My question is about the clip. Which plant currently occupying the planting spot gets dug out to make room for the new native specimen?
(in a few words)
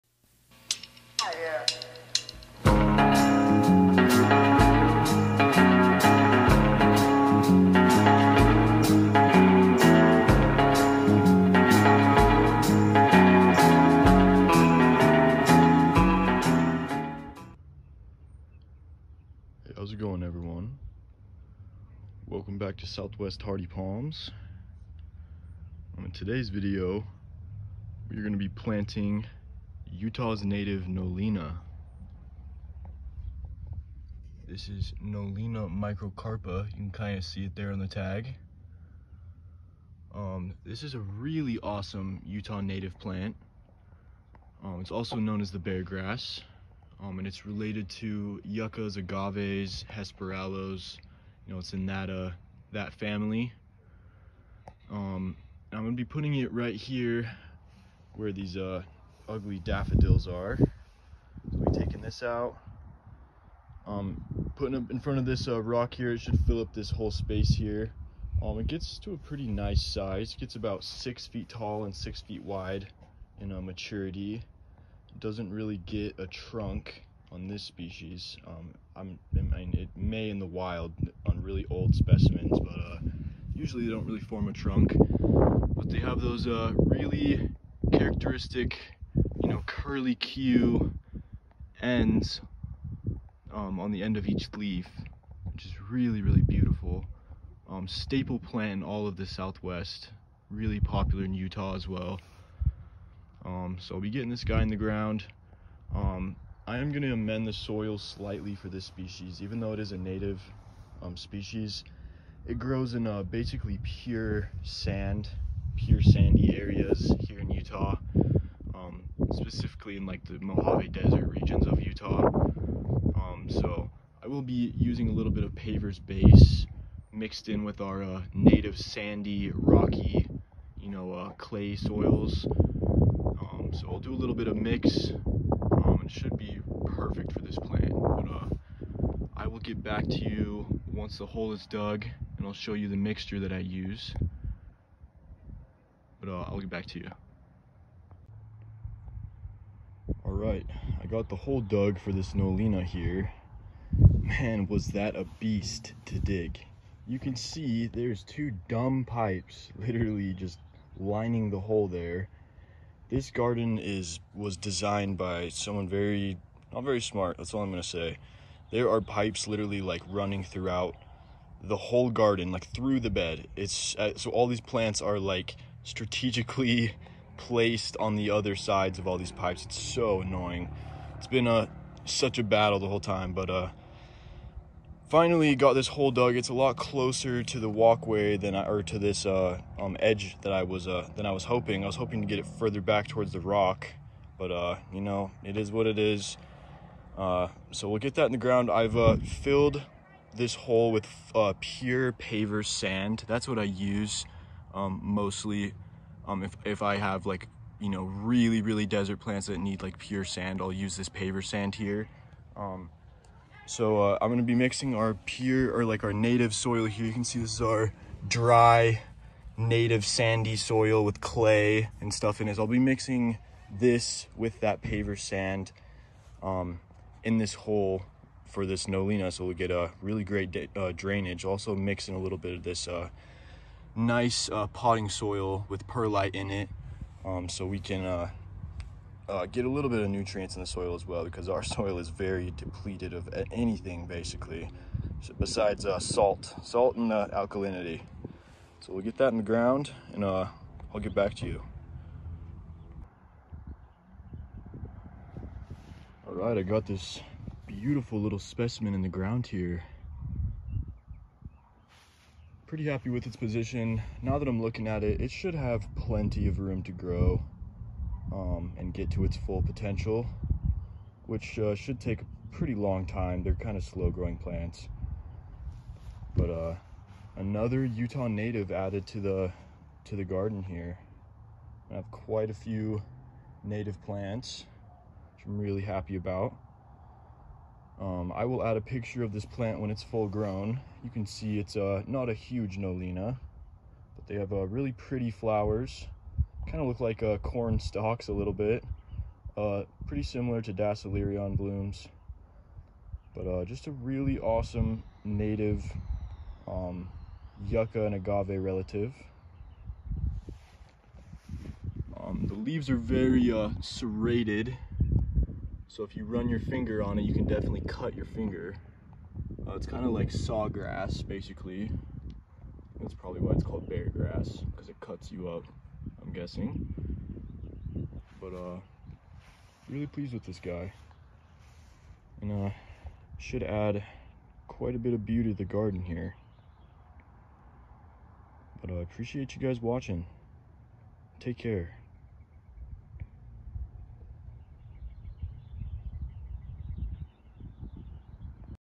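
daffodils.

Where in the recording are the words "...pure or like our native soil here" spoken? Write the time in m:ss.
3:35.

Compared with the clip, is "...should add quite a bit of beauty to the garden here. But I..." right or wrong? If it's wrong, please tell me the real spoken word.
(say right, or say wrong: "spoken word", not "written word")
right.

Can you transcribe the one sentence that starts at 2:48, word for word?
There are pipes literally like running throughout the whole garden, like through the bed.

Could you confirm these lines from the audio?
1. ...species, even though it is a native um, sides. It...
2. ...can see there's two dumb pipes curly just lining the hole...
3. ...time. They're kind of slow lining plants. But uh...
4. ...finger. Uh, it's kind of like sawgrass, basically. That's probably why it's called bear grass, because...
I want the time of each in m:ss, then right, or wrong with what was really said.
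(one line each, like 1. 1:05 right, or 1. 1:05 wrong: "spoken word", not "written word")
1. 1:48 wrong: "species", not "sides"
2. 2:37 wrong: "literally", not "curly"
3. 4:33 wrong: "growing", not "lining"
4. 5:18 right.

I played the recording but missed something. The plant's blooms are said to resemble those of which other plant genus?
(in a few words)
Dasylirion.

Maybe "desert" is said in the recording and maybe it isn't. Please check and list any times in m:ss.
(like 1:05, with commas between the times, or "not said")
2:00, 3:28.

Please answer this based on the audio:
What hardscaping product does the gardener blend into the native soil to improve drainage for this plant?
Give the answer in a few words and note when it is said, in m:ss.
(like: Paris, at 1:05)
Paver's base, at 2:05.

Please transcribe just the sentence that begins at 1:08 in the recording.
Um, it gets to a pretty nice size.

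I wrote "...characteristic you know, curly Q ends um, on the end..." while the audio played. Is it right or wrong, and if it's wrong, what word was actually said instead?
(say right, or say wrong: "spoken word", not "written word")
right.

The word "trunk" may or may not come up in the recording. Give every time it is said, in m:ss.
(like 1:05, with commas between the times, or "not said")
1:16, 1:24.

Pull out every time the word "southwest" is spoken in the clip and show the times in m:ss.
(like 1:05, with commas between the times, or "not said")
0:22, 1:39.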